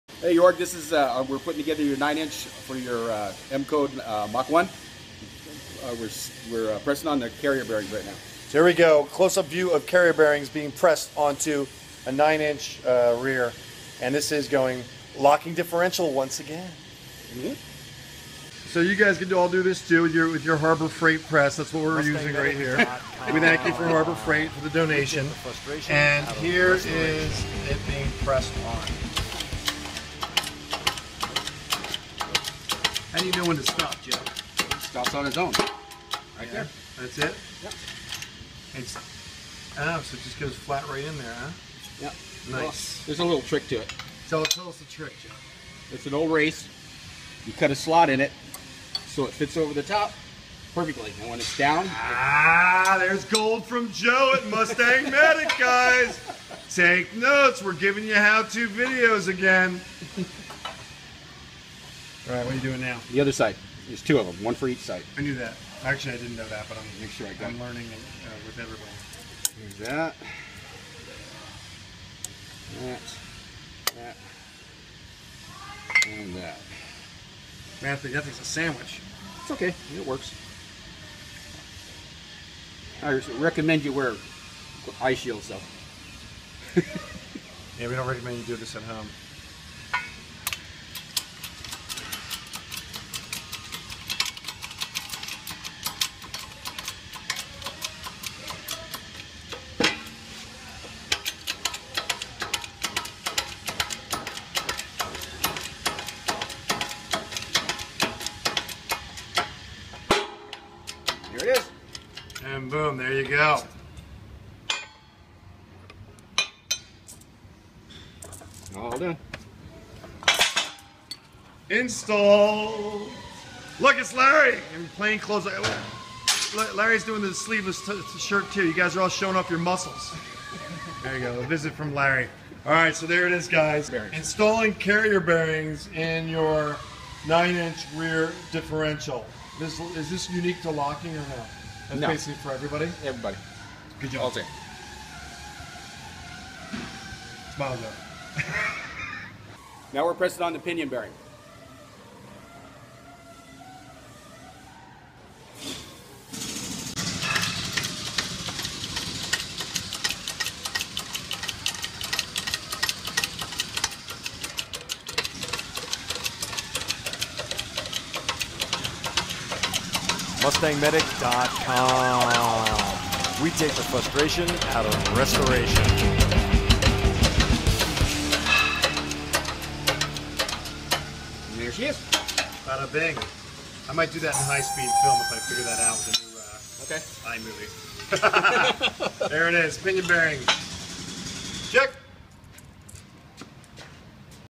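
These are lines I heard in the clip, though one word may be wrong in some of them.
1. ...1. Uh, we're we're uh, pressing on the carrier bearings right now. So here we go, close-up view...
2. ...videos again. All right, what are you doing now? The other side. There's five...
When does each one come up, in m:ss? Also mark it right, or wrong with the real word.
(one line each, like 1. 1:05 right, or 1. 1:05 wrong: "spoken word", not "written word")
1. 0:04 right
2. 0:58 wrong: "two", not "five".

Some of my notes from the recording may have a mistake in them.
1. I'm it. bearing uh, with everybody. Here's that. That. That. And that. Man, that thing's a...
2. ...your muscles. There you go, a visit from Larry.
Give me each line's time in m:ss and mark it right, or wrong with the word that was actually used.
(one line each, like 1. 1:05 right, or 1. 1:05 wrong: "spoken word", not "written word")
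1. 1:07 wrong: "learning", not "bearing"
2. 2:09 right.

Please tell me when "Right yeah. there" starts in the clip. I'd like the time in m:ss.
0:35.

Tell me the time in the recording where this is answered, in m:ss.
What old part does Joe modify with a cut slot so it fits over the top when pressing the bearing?
0:46.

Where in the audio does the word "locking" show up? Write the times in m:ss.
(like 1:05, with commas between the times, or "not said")
0:15, 2:20.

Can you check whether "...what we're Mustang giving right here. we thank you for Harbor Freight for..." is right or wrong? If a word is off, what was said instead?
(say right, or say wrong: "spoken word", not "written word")
wrong: "using", not "giving".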